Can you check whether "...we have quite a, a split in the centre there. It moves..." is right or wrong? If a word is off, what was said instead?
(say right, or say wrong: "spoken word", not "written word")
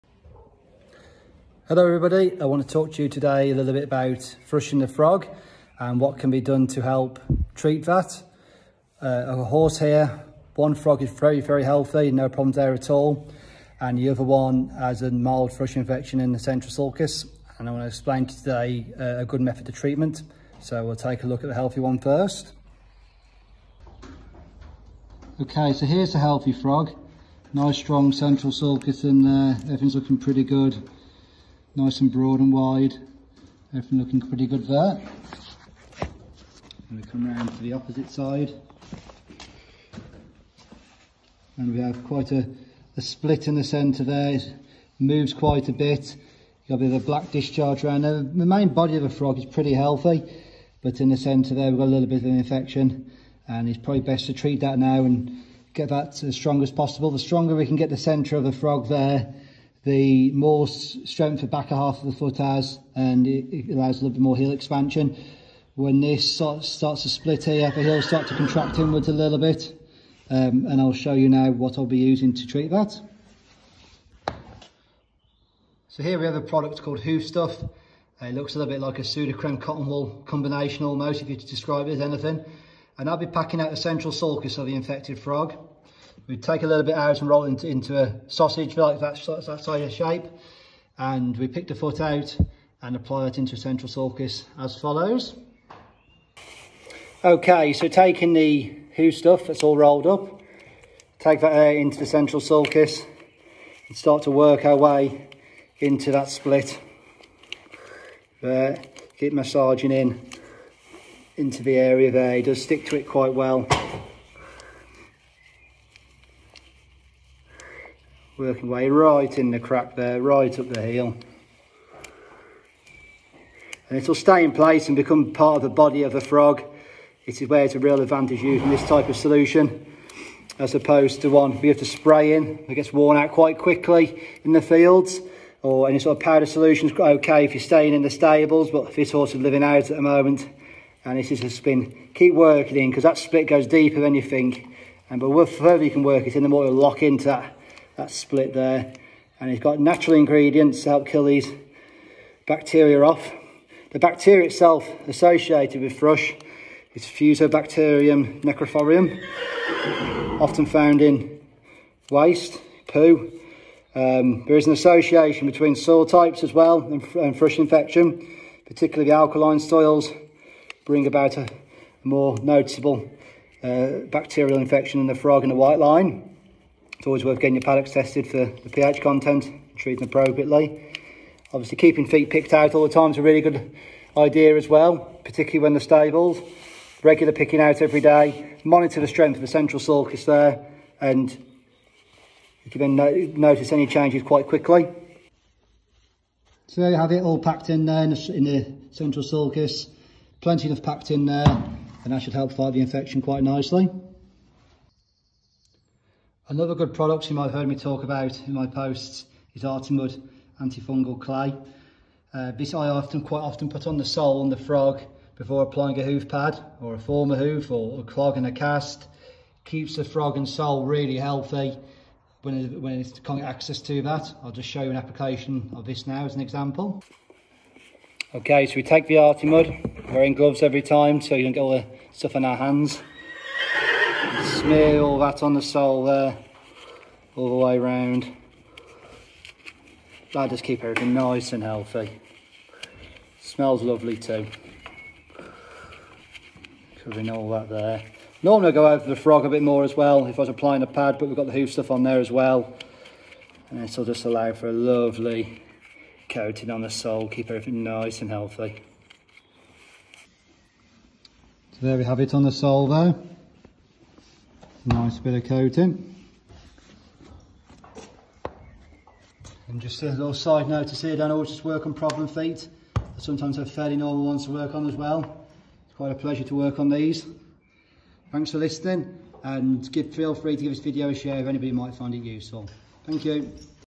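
right.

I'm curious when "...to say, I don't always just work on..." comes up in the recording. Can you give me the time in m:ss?
4:30.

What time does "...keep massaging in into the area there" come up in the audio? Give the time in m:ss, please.
1:49.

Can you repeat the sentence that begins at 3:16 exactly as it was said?
So there you have it, all packed in there in the, in the central sulcus.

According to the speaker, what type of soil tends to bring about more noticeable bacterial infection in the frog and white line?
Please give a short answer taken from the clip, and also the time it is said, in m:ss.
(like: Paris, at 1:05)
alkaline soils, at 2:49.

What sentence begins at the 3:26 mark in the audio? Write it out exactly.
Another good product you might have heard me talk about in my posts is Artimud antifungal clay.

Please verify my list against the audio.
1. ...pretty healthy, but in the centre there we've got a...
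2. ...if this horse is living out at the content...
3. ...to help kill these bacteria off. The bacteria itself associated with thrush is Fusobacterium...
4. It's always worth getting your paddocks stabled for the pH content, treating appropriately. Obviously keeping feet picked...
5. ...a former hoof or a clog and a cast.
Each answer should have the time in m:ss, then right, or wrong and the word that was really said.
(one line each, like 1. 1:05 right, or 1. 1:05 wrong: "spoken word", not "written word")
1. 0:49 right
2. 2:18 wrong: "moment", not "content"
3. 2:30 right
4. 2:57 wrong: "tested", not "stabled"
5. 3:36 right.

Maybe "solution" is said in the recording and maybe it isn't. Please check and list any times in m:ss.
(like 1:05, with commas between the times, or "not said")
2:09, 2:16.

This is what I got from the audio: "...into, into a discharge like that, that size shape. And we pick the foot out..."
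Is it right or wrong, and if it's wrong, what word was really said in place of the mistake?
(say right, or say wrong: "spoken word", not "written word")
wrong: "sausage", not "discharge".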